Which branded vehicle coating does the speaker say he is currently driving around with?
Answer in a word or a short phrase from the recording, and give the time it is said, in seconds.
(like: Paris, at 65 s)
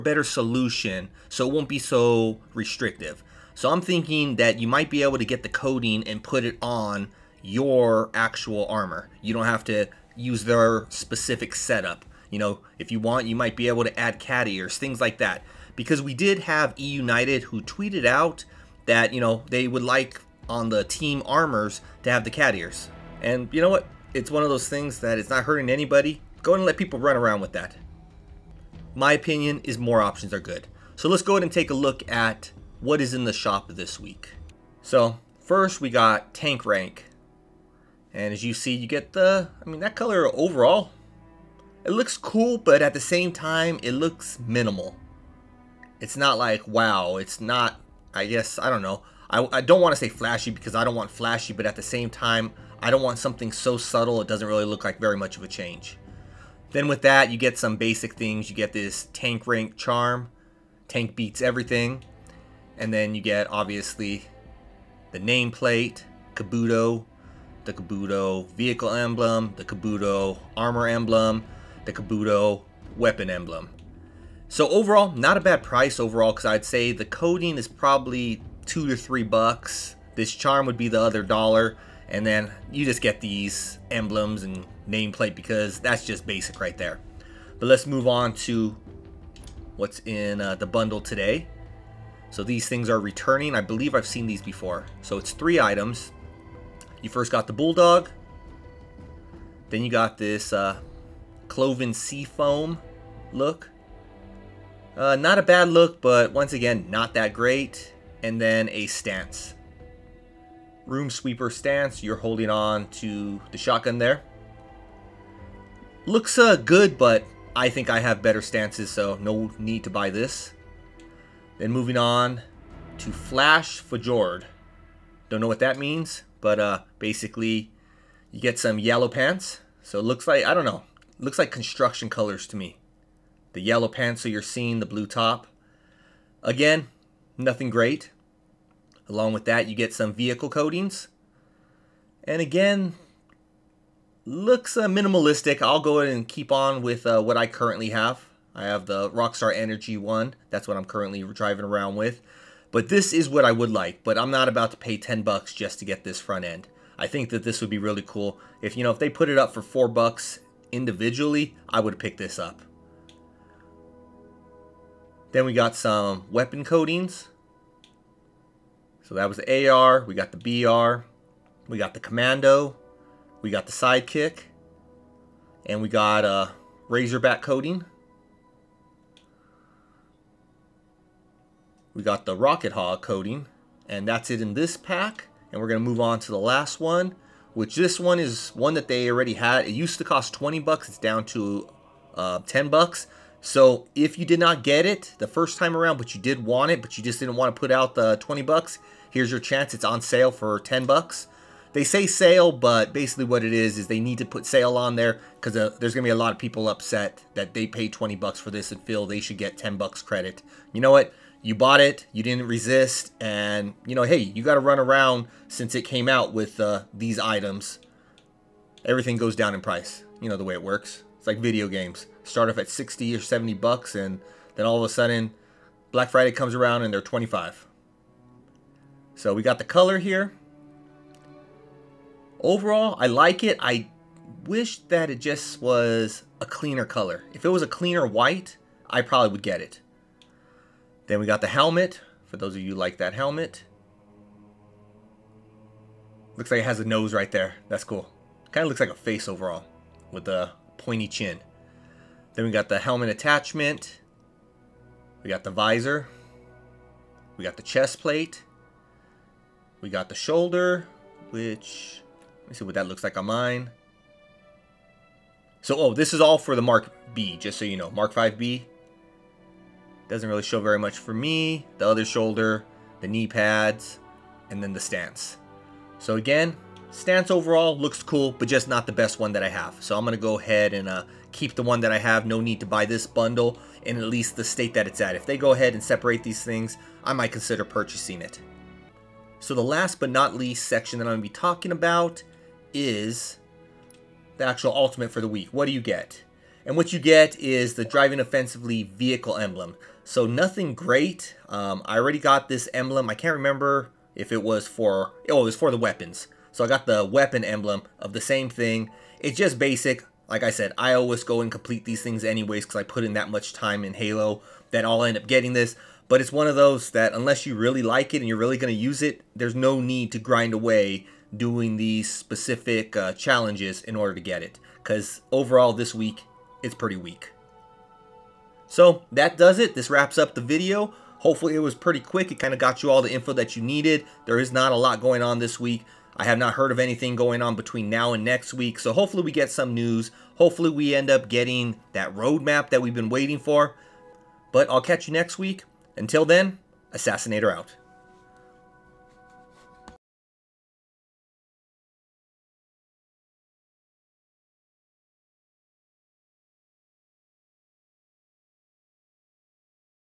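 Rockstar Energy, at 149 s.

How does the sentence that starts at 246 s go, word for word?
Looks like it has a nose right there.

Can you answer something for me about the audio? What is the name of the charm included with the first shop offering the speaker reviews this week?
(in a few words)
Tank rank charm.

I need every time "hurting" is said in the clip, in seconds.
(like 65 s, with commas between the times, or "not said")
25 s.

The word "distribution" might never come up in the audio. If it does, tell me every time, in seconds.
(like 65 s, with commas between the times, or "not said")
not said.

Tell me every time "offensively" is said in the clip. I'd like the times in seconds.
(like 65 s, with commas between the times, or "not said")
298 s.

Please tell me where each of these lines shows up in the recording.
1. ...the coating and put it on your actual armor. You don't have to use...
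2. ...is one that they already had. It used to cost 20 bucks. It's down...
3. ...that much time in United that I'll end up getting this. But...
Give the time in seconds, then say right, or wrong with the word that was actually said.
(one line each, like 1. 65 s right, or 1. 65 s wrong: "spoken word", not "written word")
1. 5 s right
2. 188 s right
3. 313 s wrong: "Halo", not "United".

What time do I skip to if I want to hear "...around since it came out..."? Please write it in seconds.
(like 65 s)
214 s.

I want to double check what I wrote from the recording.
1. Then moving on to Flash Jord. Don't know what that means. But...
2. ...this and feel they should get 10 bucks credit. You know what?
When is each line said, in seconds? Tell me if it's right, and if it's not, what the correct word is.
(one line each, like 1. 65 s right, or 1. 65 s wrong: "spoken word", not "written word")
1. 121 s right
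2. 208 s right.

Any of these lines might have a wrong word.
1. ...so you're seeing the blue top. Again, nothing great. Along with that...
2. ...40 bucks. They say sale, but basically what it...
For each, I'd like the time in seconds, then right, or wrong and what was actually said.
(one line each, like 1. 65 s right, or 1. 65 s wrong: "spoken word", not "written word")
1. 134 s right
2. 200 s wrong: "10", not "40".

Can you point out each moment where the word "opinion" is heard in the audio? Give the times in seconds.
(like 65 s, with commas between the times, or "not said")
29 s.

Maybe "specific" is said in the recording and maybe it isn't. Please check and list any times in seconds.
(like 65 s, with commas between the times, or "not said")
10 s, 322 s.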